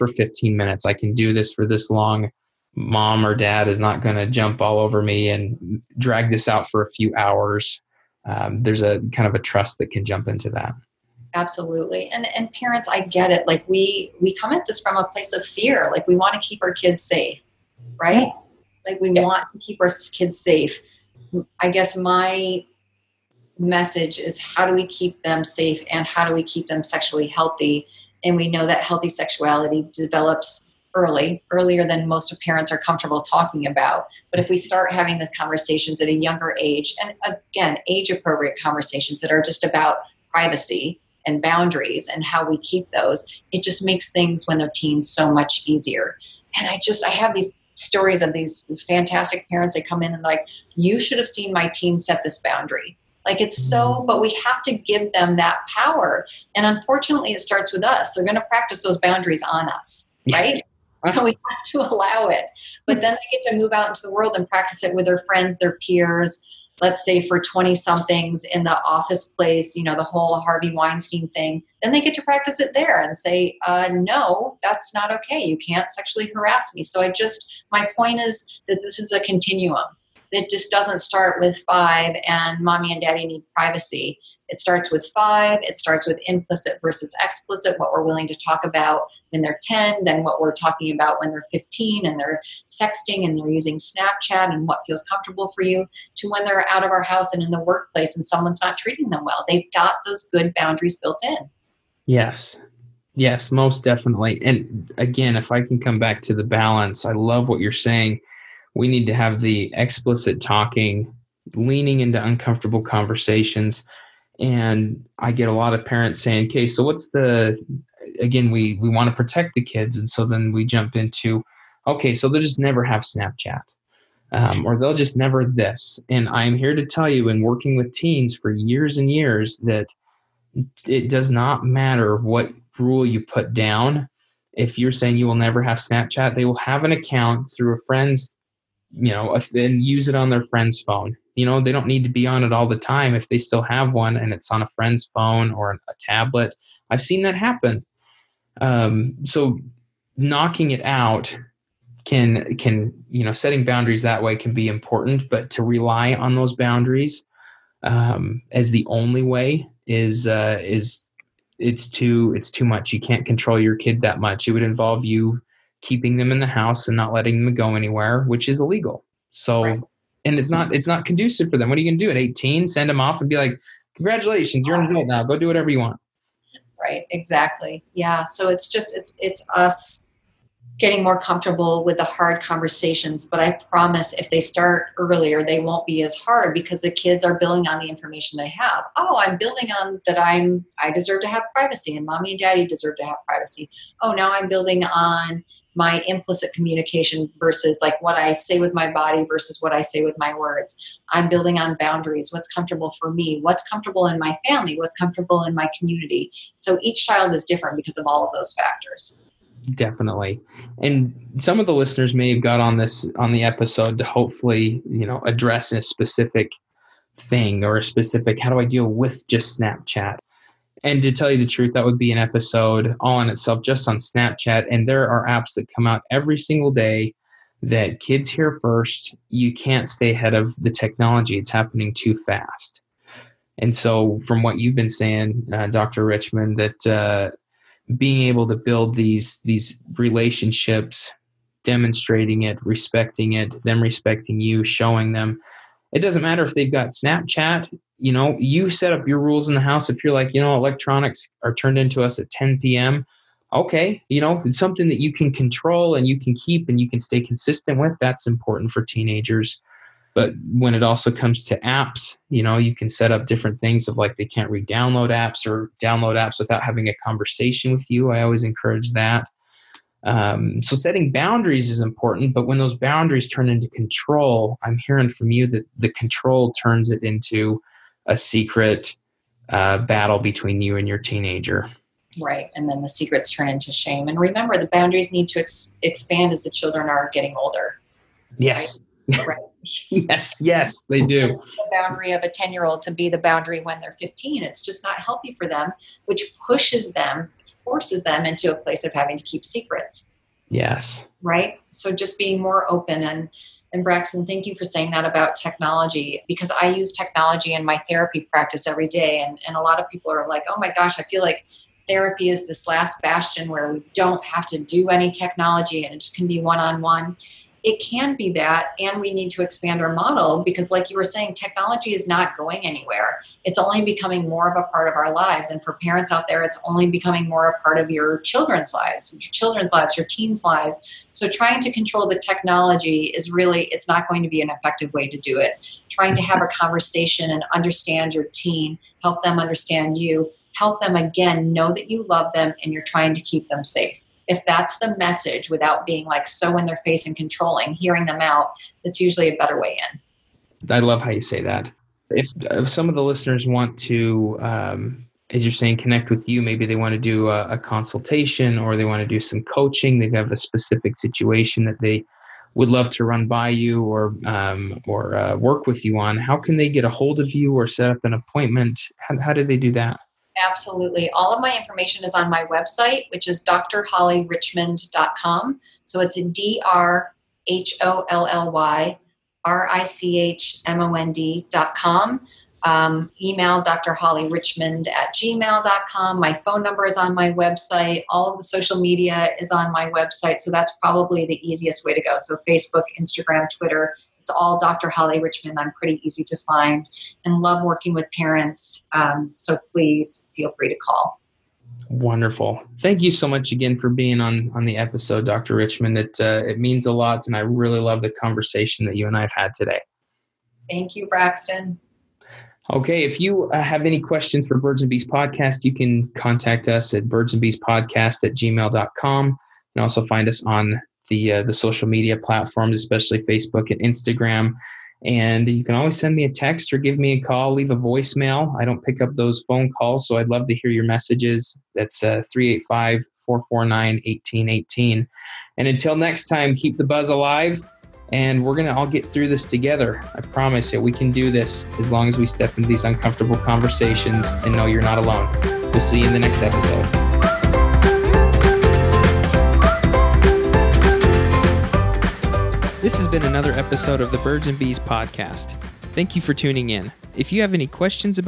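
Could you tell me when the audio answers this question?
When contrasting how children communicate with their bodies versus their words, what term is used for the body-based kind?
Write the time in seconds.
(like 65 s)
196 s.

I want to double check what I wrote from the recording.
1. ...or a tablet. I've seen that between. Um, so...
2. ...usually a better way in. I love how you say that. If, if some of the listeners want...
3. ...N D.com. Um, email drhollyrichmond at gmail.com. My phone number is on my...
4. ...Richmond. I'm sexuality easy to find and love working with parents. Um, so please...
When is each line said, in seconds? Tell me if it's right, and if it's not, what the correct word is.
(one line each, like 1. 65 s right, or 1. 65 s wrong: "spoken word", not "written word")
1. 145 s wrong: "happen", not "between"
2. 349 s right
3. 380 s right
4. 395 s wrong: "pretty", not "sexuality".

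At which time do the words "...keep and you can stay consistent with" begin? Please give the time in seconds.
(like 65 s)
256 s.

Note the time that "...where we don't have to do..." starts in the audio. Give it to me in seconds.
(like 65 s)
313 s.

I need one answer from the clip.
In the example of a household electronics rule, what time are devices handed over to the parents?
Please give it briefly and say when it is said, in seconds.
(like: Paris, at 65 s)
10 p.m., at 252 s.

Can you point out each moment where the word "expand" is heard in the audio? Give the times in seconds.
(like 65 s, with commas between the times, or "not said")
285 s, 319 s.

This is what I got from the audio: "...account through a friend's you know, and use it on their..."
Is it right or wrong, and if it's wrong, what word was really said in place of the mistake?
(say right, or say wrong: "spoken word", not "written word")
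right.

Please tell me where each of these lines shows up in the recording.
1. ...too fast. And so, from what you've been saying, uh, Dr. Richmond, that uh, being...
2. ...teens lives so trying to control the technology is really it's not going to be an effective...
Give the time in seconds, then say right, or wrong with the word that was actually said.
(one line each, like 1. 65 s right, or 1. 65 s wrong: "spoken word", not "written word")
1. 231 s right
2. 330 s right.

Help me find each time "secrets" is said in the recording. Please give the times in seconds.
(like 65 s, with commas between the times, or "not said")
278 s, 282 s, 299 s.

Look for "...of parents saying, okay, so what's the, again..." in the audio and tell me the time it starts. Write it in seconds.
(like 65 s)
115 s.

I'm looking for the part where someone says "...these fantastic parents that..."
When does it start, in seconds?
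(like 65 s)
48 s.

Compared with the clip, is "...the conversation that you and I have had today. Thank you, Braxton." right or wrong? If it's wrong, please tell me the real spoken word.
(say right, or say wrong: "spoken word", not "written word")
right.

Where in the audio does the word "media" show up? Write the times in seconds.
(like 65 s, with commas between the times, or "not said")
388 s, 421 s.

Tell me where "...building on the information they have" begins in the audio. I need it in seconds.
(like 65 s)
187 s.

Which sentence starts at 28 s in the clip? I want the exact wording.
And we know that healthy sexuality develops early, earlier than most parents are comfortable talking about.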